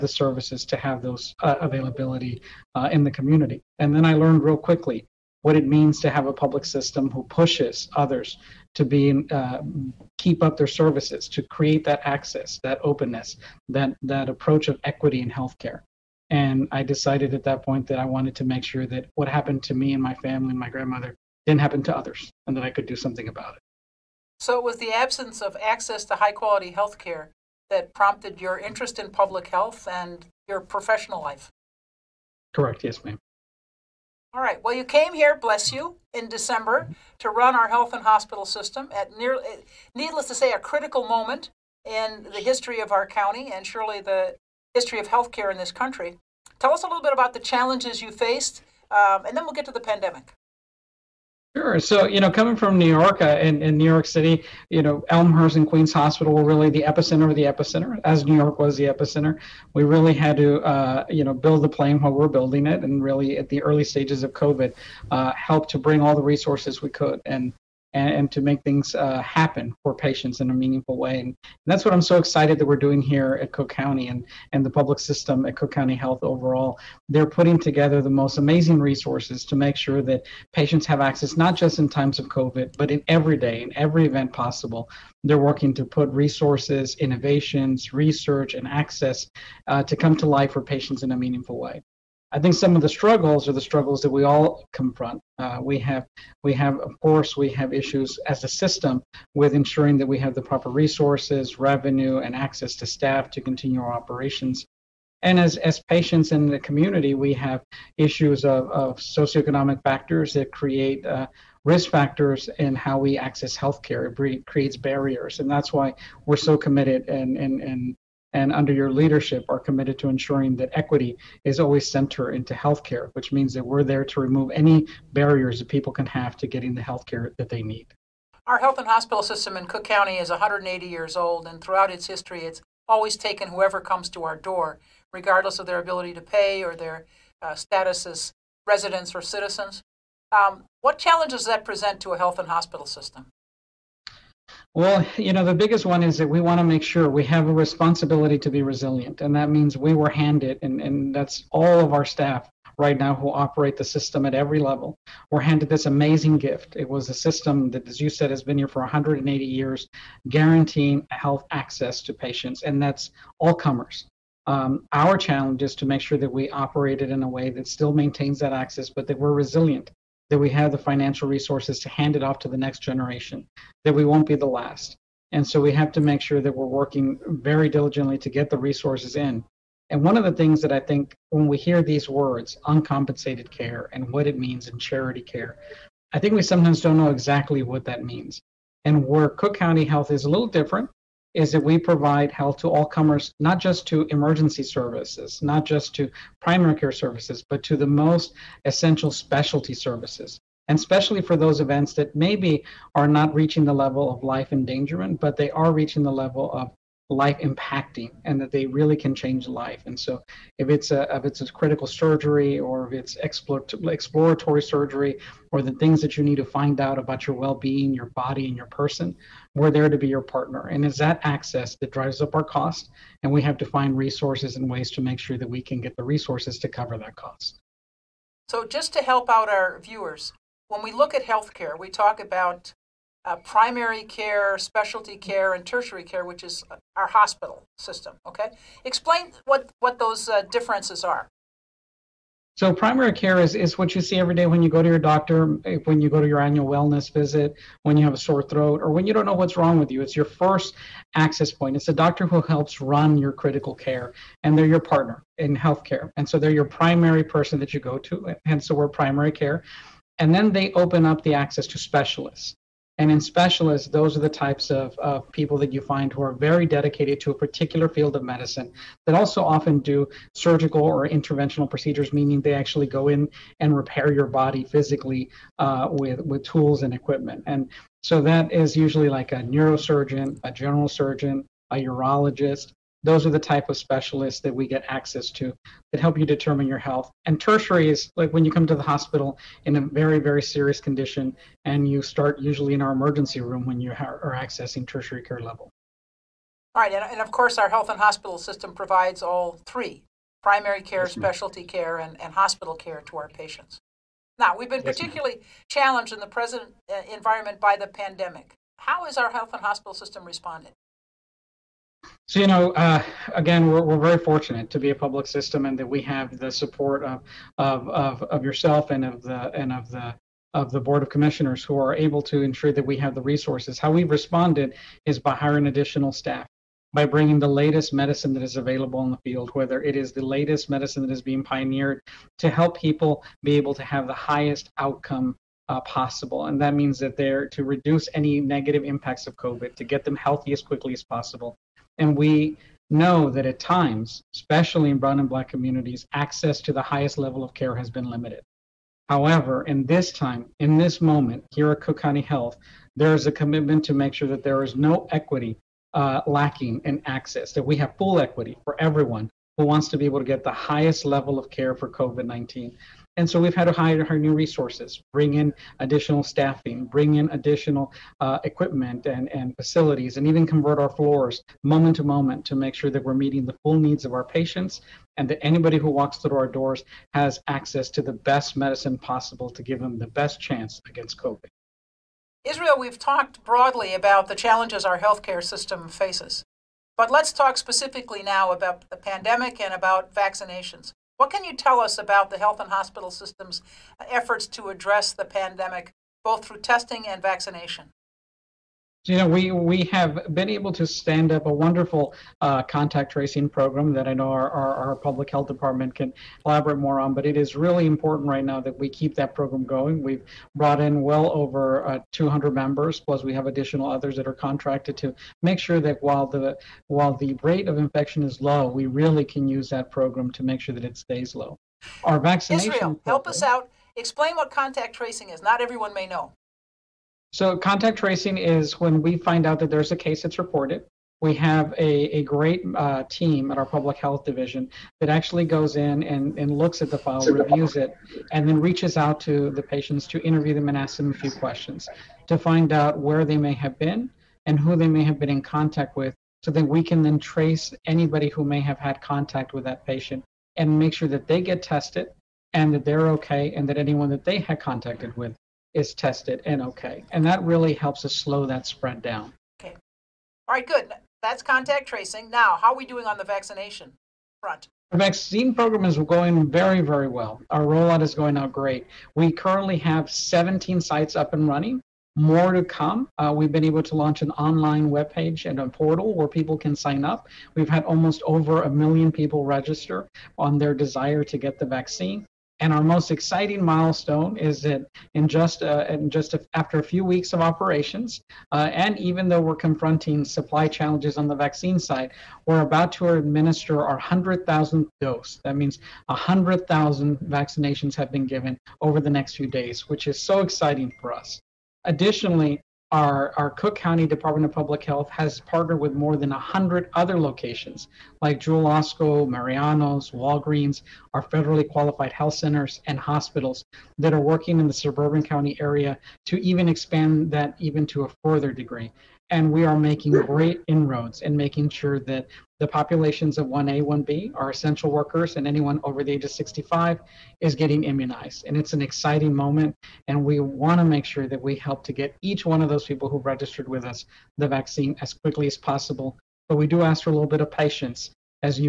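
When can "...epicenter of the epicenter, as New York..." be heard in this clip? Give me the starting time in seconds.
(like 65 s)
56 s.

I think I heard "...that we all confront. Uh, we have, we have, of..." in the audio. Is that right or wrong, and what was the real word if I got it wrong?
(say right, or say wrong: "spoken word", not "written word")
right.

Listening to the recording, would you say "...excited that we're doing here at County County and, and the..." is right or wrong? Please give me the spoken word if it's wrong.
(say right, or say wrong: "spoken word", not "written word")
wrong: "Cook", not "County".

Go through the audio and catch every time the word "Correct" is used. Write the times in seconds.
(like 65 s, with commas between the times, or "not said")
32 s.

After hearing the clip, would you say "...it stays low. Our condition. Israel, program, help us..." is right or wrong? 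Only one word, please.
wrong.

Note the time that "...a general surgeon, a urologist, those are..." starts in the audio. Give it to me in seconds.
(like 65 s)
280 s.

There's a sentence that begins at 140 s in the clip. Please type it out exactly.
Um, what challenges does that present to a health and hospital system?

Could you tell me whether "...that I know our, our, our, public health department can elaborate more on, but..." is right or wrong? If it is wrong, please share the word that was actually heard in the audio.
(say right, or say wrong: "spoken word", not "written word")
right.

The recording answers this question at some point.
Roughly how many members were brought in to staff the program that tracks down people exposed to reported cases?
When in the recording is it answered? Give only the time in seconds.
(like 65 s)
412 s.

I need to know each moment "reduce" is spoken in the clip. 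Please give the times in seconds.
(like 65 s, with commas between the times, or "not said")
337 s.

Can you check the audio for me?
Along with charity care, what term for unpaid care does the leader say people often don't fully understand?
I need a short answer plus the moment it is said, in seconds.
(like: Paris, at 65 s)
uncompensated care, at 182 s.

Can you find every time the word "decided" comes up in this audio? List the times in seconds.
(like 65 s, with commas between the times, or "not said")
16 s.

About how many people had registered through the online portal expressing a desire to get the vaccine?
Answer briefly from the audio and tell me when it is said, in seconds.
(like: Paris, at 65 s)
a million, at 478 s.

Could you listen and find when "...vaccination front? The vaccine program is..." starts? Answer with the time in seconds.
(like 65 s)
463 s.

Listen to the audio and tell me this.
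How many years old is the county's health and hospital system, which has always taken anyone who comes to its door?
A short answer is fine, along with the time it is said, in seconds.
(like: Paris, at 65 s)
180, at 130 s.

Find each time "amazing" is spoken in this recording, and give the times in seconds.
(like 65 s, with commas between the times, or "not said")
78 s, 155 s.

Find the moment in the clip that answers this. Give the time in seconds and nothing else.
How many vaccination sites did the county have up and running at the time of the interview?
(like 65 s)
470 s.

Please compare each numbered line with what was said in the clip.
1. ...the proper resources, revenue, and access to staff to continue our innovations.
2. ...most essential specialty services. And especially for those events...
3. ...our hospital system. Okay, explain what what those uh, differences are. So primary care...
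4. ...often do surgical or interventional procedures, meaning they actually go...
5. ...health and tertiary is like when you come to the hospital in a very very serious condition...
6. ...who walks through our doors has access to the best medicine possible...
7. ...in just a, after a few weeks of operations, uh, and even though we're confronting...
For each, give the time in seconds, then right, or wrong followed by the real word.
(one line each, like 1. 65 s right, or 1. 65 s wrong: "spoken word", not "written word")
1. 100 s wrong: "operations", not "innovations"
2. 197 s right
3. 236 s right
4. 269 s right
5. 286 s right
6. 375 s right
7. 485 s right.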